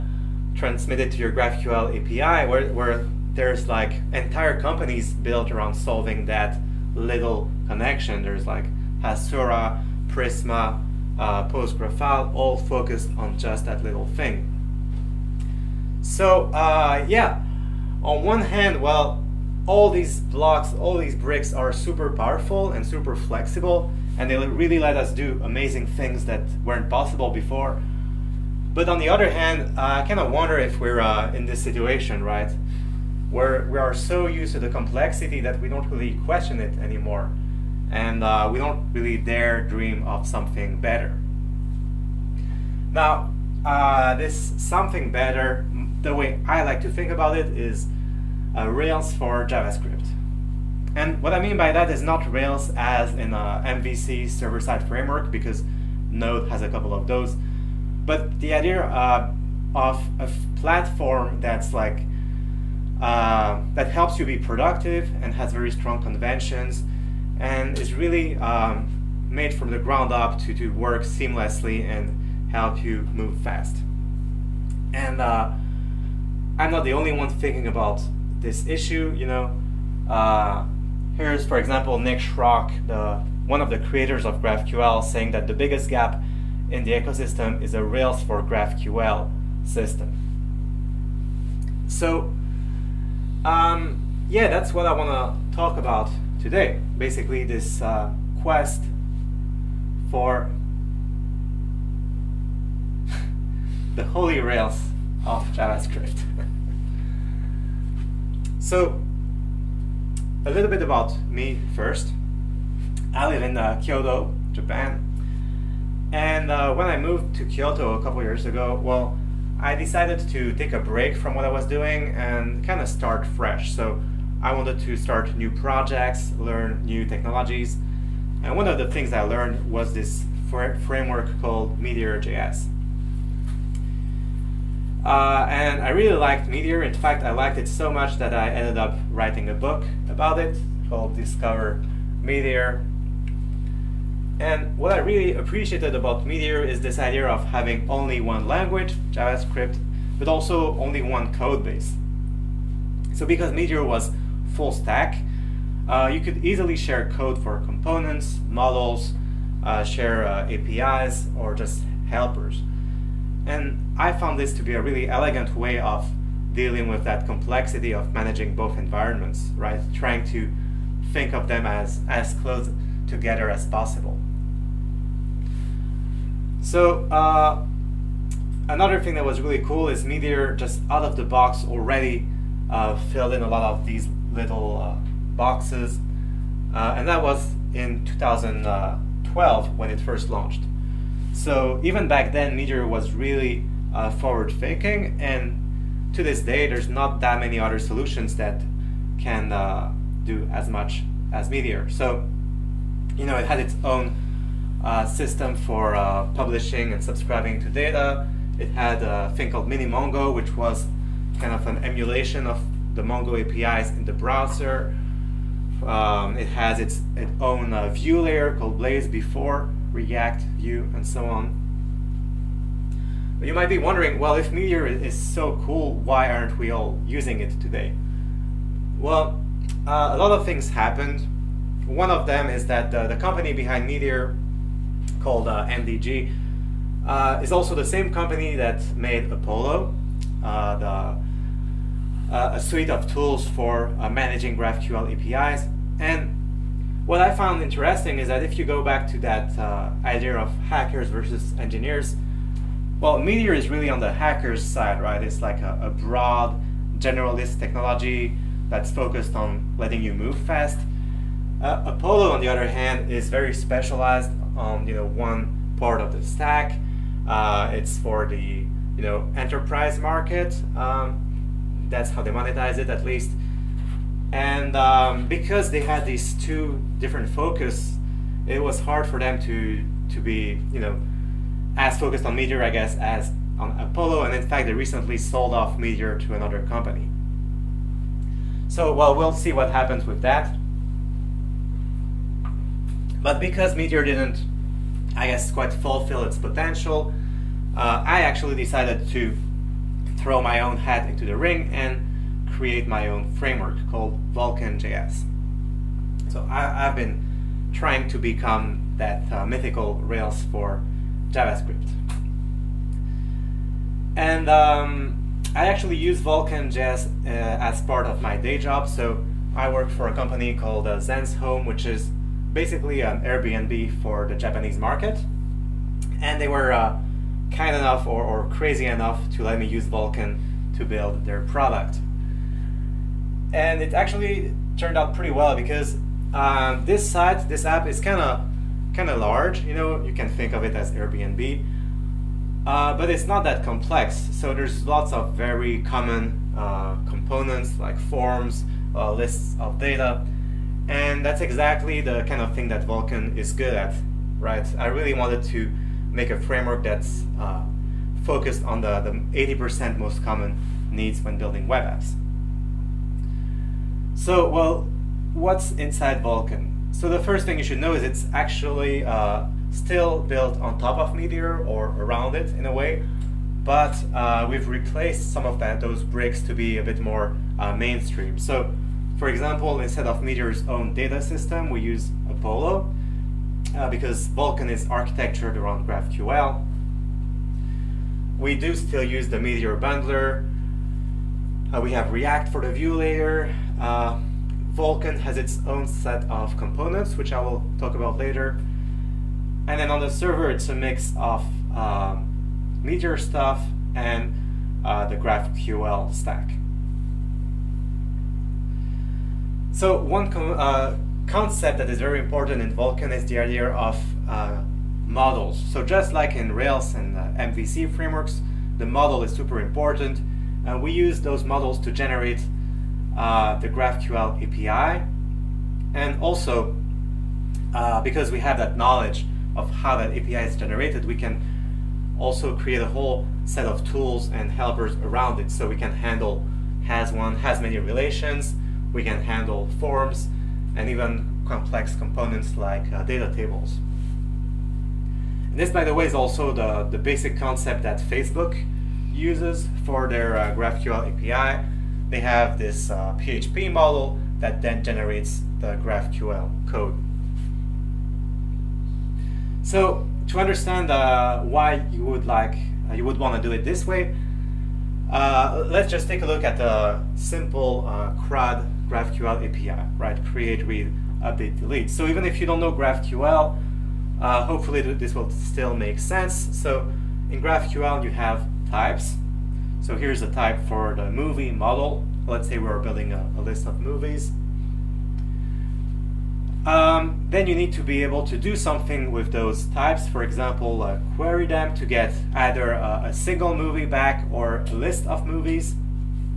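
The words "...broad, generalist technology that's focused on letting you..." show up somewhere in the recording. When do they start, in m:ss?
4:15.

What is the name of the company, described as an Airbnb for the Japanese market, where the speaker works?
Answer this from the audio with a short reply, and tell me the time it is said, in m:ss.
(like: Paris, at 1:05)
Zen's Home, at 5:20.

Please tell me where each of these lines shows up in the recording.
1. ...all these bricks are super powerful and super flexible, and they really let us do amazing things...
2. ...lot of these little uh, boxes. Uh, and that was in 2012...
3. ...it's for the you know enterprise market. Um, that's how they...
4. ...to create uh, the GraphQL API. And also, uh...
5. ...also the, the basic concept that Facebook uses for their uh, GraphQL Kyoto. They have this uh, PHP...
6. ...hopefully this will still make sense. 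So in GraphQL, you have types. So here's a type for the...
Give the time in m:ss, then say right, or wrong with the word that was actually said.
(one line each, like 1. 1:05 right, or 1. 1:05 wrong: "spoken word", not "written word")
1. 0:20 right
2. 3:03 right
3. 4:27 right
4. 7:01 wrong: "generate", not "create"
5. 7:26 wrong: "API", not "Kyoto"
6. 7:54 right.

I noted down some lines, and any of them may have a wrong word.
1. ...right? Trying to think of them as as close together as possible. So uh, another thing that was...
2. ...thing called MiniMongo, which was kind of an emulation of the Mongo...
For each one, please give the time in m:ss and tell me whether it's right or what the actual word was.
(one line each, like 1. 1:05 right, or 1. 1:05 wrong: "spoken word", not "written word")
1. 2:49 right
2. 3:29 right.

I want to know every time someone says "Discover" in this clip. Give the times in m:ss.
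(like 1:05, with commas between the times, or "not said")
2:21.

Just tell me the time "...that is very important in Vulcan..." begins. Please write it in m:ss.
6:51.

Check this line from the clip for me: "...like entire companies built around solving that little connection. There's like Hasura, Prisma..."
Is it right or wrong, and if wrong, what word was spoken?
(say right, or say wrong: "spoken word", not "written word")
right.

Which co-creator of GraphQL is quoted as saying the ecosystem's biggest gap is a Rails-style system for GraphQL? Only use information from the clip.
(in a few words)
Nick Schrock.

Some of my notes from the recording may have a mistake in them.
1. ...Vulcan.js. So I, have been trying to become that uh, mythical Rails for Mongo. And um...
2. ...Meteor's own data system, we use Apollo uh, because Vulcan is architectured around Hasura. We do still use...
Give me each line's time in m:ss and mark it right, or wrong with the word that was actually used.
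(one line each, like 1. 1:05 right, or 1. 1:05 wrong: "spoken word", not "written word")
1. 5:04 wrong: "JavaScript", not "Mongo"
2. 6:20 wrong: "GraphQL", not "Hasura".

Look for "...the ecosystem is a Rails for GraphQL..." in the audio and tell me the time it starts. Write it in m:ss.
1:26.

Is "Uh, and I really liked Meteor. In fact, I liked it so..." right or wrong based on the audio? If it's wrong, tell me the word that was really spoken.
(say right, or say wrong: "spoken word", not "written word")
right.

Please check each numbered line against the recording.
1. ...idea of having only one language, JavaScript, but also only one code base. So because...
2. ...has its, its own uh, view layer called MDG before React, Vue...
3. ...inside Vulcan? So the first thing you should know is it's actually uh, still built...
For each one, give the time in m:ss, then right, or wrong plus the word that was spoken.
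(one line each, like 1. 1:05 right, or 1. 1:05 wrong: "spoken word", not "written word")
1. 2:26 right
2. 3:36 wrong: "Blaze", not "MDG"
3. 6:05 right.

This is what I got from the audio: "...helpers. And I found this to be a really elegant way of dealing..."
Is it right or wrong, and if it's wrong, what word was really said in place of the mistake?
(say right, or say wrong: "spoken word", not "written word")
right.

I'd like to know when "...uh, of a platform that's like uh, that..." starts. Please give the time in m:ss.
0:58.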